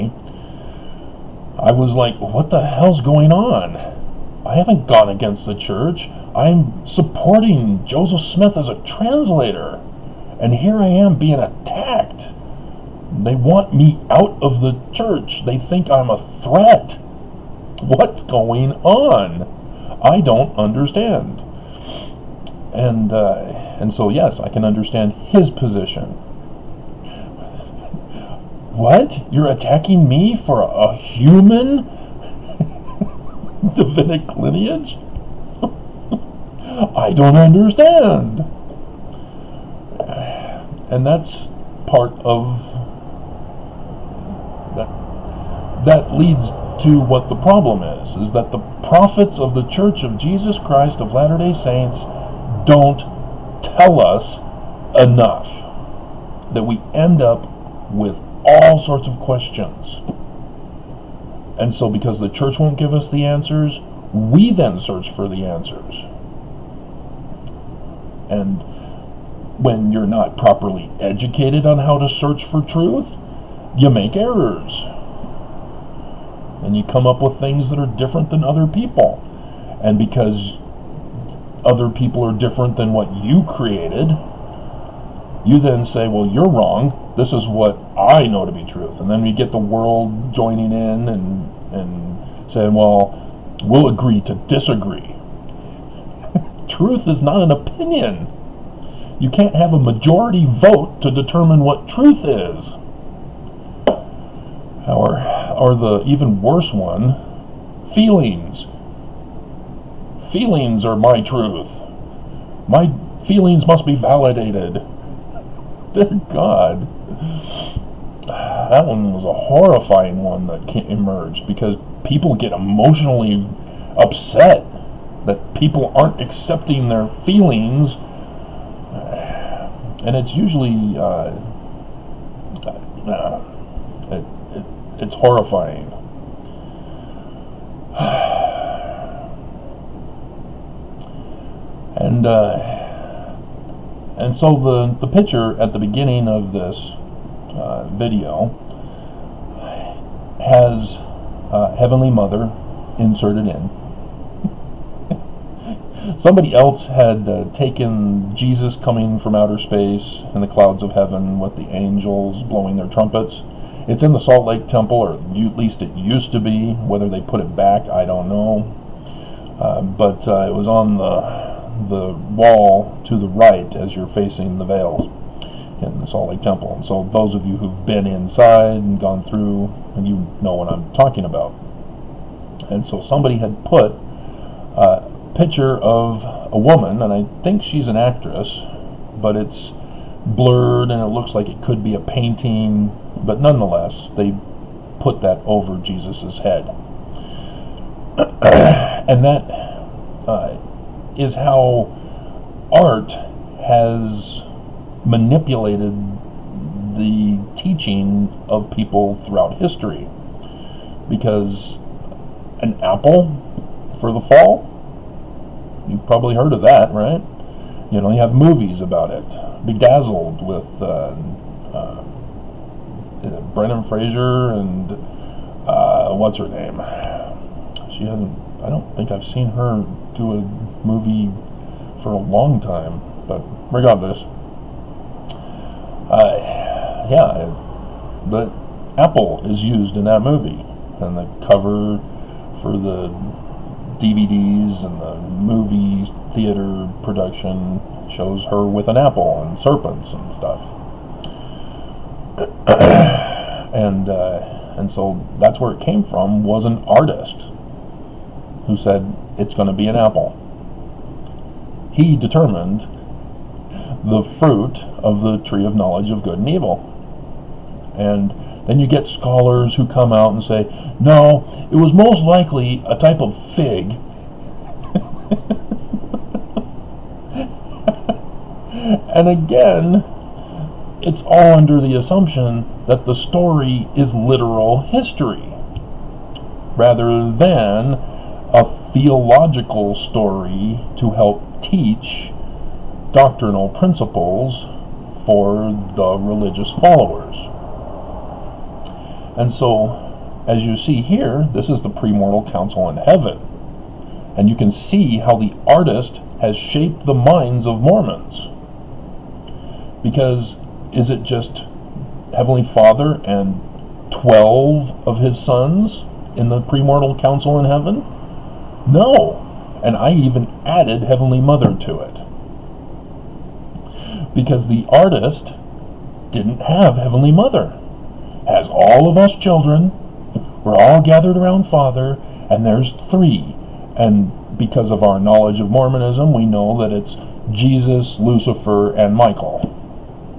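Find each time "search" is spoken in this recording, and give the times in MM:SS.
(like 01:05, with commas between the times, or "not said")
01:04, 01:12.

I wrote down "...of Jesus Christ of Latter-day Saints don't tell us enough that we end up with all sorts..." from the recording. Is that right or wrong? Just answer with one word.
right.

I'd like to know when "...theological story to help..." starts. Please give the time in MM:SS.
04:48.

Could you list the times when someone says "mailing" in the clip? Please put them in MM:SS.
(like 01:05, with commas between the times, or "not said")
not said.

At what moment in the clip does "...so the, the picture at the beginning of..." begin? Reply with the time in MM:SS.
02:24.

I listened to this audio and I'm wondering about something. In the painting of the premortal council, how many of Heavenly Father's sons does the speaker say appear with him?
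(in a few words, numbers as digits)
12.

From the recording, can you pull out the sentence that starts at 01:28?
And then we get the world joining in and, and saying, well, we'll agree to disagree.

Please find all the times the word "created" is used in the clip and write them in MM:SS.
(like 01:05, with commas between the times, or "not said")
01:23.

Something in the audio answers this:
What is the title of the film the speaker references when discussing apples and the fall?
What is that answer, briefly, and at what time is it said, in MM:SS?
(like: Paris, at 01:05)
Bedazzled, at 03:39.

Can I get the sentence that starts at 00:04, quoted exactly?
I haven't gone against the church.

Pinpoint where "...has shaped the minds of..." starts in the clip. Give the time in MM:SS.
05:06.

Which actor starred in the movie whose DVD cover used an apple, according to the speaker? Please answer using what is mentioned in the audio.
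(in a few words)
Brendan Fraser.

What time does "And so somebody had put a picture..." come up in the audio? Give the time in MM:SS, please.
03:02.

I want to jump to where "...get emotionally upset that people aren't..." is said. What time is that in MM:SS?
02:02.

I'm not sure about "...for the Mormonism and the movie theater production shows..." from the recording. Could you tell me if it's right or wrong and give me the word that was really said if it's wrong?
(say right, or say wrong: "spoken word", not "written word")
wrong: "DVDs", not "Mormonism".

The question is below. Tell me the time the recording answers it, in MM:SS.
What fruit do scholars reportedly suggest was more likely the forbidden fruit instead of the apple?
04:32.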